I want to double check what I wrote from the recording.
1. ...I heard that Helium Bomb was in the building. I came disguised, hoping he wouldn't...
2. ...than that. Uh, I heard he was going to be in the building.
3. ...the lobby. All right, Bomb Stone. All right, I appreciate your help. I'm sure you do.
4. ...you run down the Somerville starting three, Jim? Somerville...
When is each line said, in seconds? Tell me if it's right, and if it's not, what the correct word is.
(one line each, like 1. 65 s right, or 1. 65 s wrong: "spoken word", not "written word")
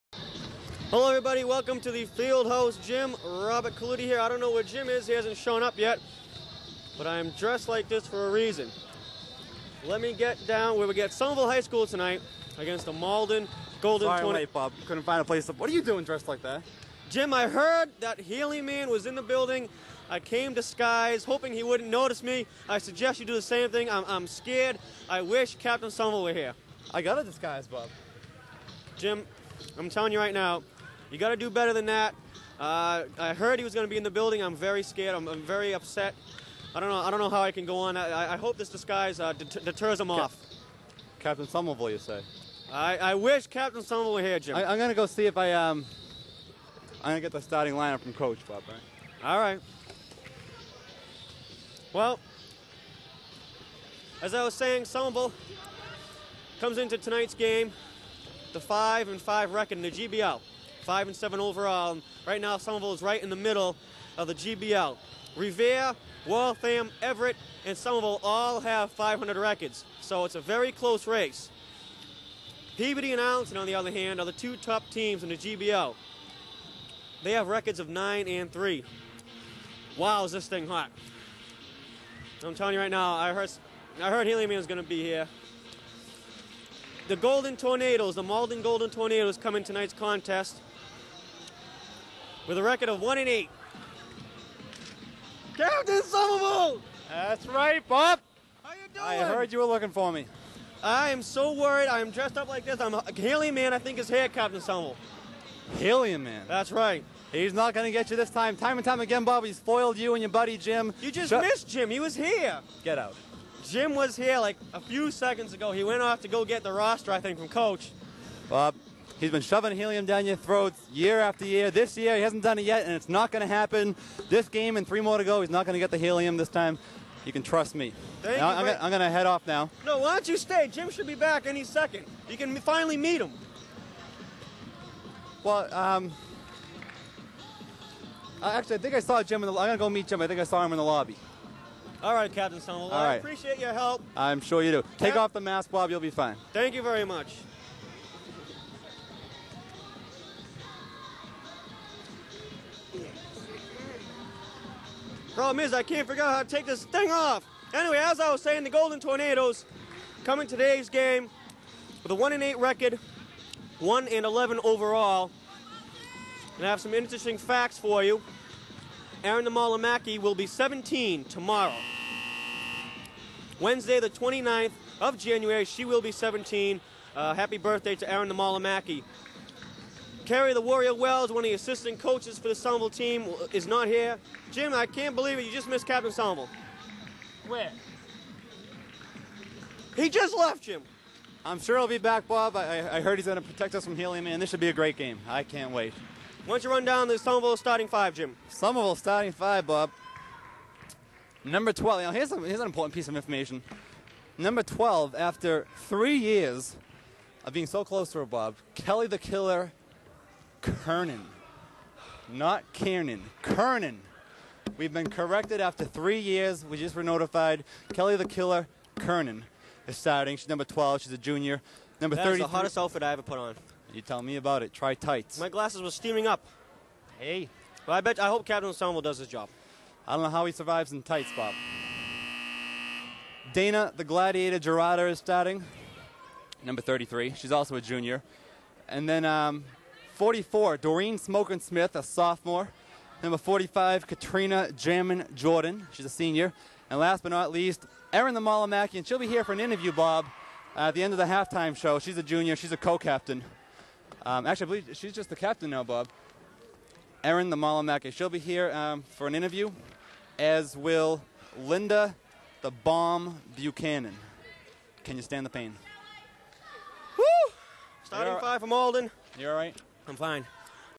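1. 17 s wrong: "Man", not "Bomb"
2. 31 s right
3. 140 s wrong: "Captain", not "Bomb"
4. 196 s wrong: "five", not "three".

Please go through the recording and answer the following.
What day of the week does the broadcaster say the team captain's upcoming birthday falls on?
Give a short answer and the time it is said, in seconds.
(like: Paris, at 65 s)
Wednesday, at 173 s.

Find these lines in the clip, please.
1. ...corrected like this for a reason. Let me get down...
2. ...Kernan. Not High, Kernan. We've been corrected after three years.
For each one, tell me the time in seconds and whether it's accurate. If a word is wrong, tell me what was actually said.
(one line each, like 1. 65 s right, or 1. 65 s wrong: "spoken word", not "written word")
1. 7 s wrong: "dressed", not "corrected"
2. 210 s wrong: "Kiernan", not "High".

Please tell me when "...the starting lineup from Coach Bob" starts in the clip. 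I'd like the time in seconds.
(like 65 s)
47 s.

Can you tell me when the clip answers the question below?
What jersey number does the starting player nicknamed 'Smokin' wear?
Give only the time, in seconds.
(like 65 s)
240 s.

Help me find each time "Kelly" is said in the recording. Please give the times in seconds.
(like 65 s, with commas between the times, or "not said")
208 s, 217 s.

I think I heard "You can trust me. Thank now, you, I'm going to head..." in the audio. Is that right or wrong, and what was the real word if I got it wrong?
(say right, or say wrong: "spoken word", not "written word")
right.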